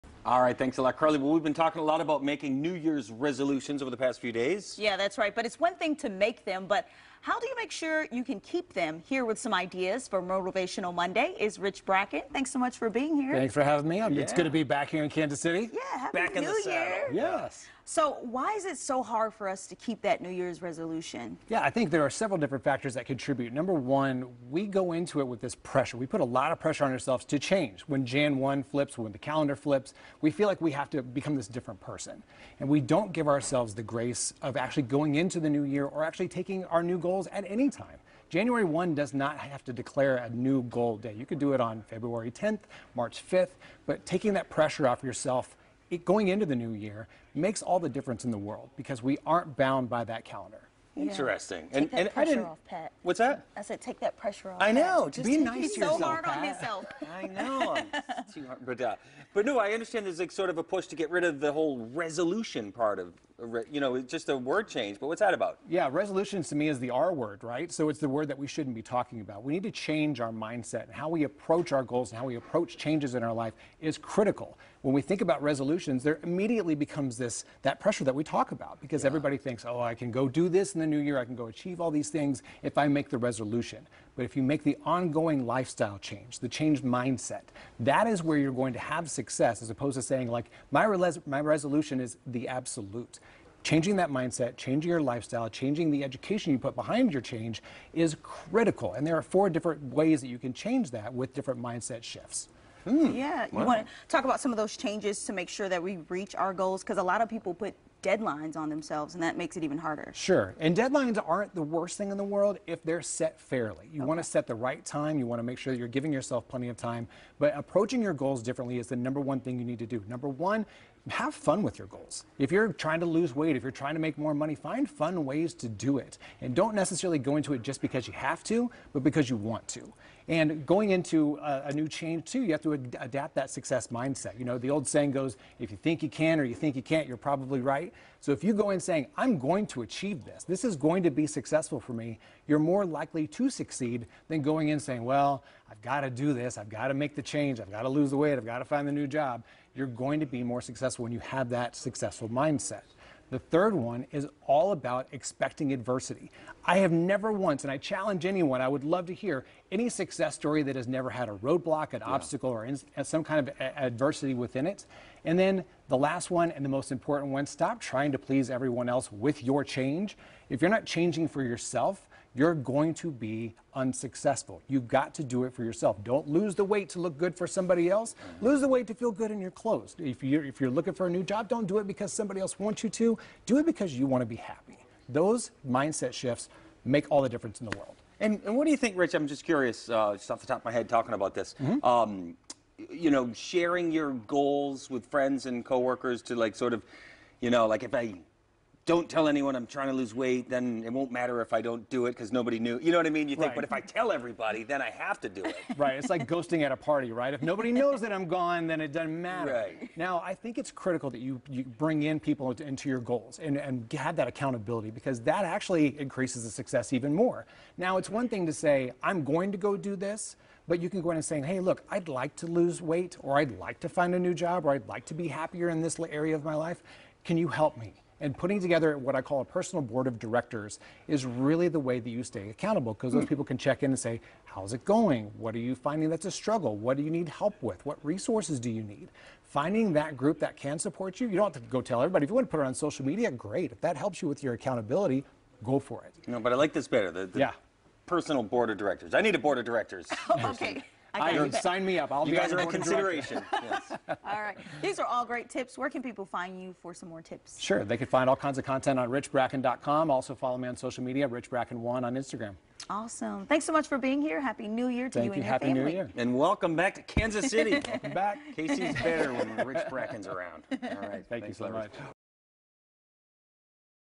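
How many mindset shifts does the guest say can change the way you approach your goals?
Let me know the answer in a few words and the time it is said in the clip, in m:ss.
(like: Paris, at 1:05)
4, at 1:39.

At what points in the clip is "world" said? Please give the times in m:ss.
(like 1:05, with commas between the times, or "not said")
0:48, 1:52, 3:07.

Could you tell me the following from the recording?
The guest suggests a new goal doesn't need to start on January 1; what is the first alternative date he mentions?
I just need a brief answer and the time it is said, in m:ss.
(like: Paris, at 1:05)
February 10th, at 0:41.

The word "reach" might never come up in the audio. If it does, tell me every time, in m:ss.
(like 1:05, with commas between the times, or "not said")
1:46.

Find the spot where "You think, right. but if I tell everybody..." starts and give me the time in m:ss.
3:23.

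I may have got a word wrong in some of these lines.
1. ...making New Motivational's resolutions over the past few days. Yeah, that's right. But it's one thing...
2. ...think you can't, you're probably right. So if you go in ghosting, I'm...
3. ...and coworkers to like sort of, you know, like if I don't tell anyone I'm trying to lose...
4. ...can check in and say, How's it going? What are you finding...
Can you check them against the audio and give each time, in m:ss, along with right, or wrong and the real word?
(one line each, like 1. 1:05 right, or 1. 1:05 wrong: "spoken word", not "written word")
1. 0:02 wrong: "Year", not "Motivational"
2. 2:16 wrong: "saying", not "ghosting"
3. 3:15 right
4. 3:53 right.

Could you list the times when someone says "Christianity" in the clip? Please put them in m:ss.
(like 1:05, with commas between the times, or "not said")
not said.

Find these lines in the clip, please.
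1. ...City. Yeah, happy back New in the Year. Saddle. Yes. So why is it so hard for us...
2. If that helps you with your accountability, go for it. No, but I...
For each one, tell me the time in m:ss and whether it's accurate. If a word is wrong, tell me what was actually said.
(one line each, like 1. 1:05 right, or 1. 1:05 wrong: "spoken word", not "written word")
1. 0:15 right
2. 4:03 right.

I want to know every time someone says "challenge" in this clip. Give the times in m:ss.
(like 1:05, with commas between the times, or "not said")
2:37.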